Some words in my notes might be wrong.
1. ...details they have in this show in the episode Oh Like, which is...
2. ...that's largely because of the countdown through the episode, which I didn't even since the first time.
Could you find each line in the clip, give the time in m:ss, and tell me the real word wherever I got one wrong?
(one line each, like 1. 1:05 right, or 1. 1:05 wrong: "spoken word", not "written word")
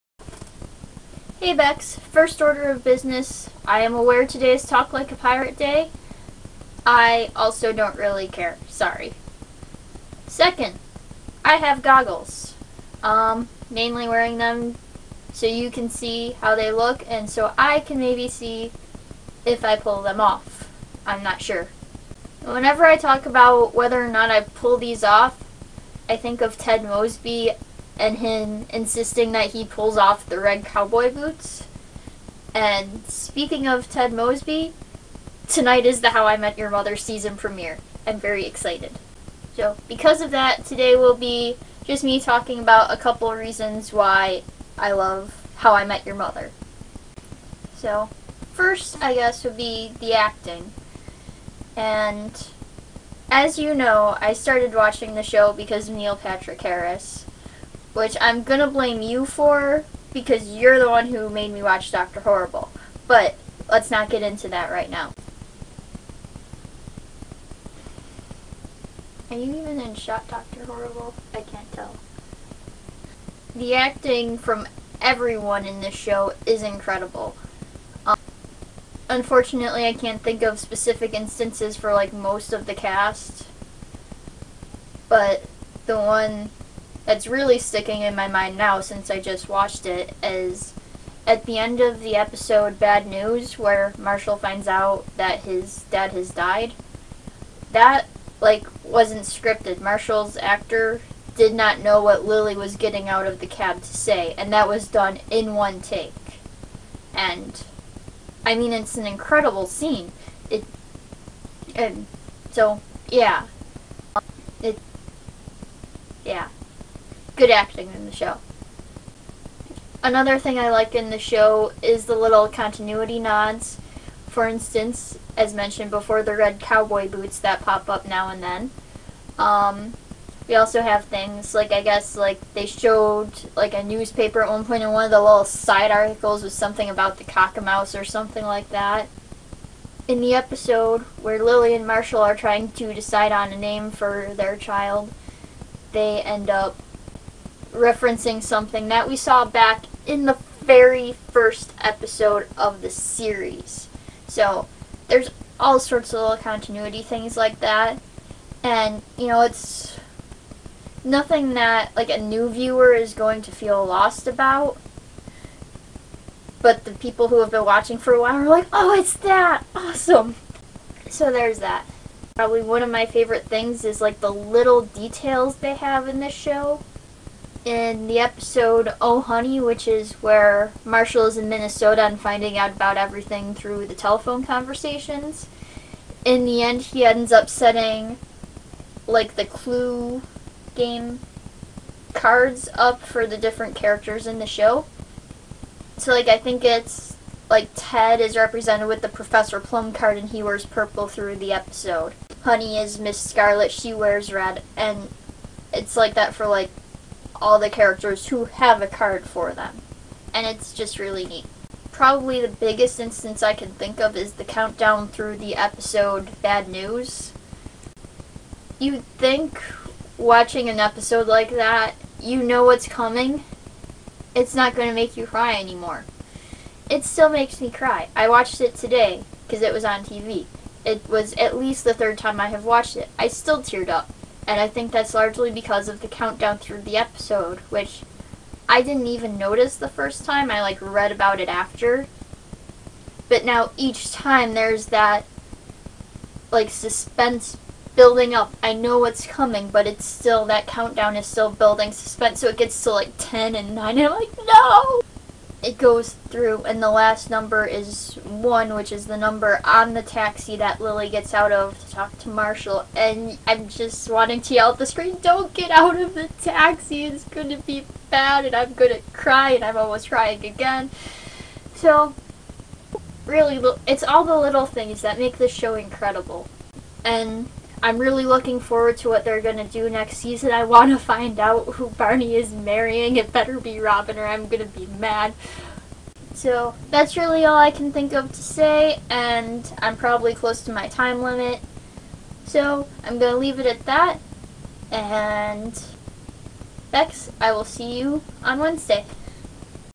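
1. 2:54 wrong: "Honey", not "Like"
2. 3:54 wrong: "notice", not "since".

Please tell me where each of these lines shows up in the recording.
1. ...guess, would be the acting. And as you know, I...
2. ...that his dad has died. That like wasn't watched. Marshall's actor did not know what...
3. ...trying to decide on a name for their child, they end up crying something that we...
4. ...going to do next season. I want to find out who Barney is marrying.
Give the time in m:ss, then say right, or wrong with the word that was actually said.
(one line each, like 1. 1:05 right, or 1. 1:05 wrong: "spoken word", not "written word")
1. 0:49 right
2. 1:35 wrong: "scripted", not "watched"
3. 2:22 wrong: "referencing", not "crying"
4. 4:39 right.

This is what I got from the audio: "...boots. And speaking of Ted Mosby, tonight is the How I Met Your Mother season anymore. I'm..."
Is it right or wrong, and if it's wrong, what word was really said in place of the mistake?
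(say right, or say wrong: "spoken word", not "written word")
wrong: "premiere", not "anymore".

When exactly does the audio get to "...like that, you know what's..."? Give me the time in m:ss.
3:41.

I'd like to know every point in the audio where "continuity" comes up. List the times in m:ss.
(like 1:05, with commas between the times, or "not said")
2:02, 2:36.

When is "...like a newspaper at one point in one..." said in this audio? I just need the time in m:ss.
2:13.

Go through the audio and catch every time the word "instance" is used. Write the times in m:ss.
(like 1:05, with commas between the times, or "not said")
1:21, 2:04, 3:32.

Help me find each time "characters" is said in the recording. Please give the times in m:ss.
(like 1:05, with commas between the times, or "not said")
3:13, 3:27.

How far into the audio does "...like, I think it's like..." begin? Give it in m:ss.
3:16.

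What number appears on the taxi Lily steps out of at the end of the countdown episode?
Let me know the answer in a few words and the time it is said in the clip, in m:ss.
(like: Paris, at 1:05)
1, at 4:18.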